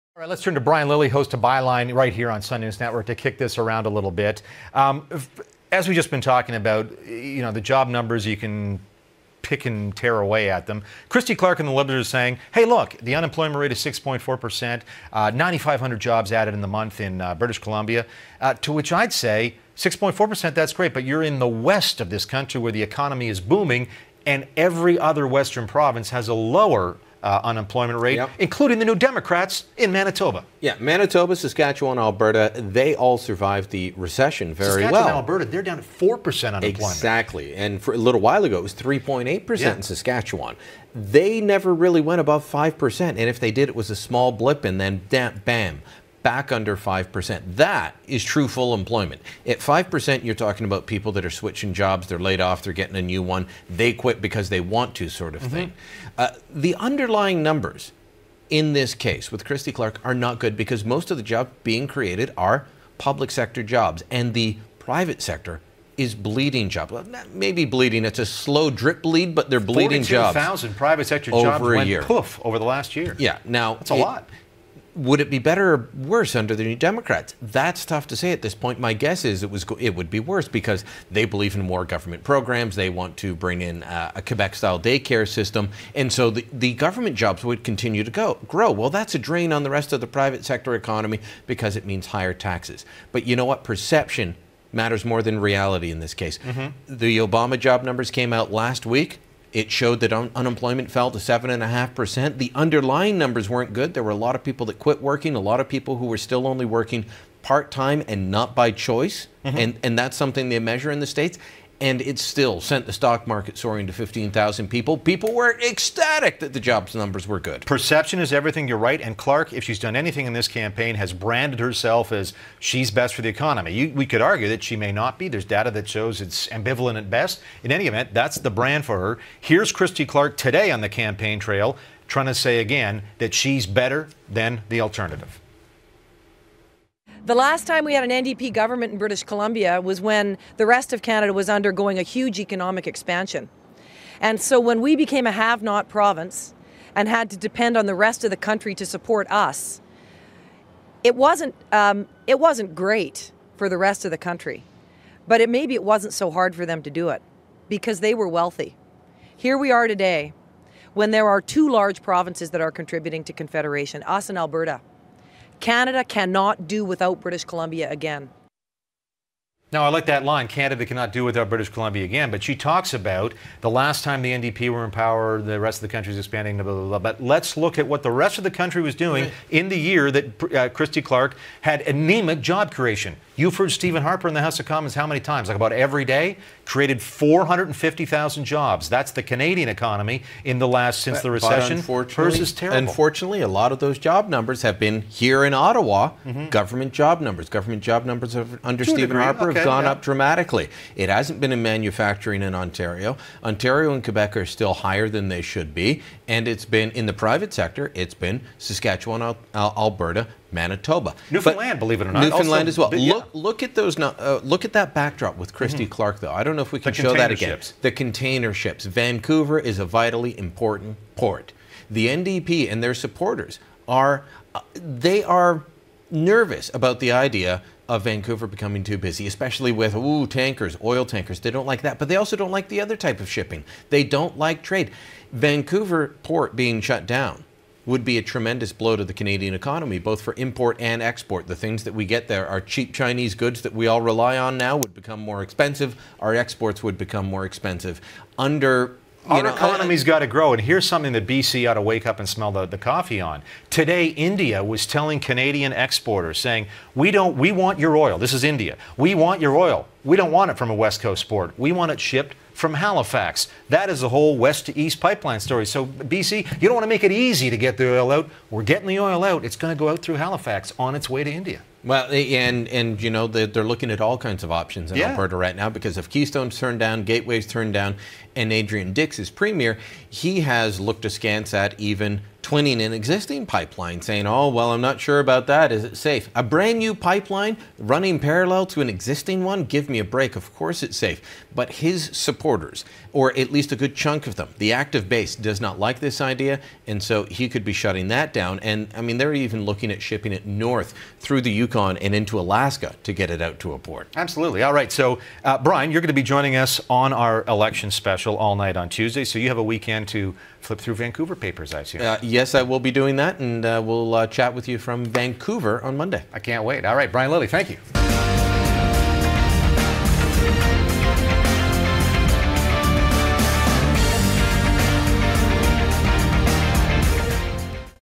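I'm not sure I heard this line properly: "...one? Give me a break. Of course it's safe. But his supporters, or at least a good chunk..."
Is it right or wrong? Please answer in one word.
right.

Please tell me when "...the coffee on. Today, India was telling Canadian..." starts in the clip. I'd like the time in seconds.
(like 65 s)
252 s.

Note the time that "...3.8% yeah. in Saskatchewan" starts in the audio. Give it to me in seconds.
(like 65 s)
38 s.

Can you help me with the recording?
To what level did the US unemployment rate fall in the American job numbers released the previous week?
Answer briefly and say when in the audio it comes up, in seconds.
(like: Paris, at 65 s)
7.5%, at 101 s.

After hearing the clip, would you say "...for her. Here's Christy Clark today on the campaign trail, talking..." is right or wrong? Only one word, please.
wrong.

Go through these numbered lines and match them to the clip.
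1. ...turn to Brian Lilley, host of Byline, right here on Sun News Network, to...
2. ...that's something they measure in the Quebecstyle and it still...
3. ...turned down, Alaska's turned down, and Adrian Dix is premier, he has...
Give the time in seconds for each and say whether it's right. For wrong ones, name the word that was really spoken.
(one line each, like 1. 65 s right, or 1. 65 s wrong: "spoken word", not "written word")
1. 0 s right
2. 109 s wrong: "States", not "Quebecstyle"
3. 276 s wrong: "Gateway", not "Alaska".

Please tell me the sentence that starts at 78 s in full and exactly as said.
My guess is it was it would be worse because they believe in more government programs.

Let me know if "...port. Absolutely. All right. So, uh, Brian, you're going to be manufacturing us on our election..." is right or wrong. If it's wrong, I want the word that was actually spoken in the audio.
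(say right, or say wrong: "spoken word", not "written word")
wrong: "joining", not "manufacturing".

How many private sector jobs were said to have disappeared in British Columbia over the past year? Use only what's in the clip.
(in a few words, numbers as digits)
42,000.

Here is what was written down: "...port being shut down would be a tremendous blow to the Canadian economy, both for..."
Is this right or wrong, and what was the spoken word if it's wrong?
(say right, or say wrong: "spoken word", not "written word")
right.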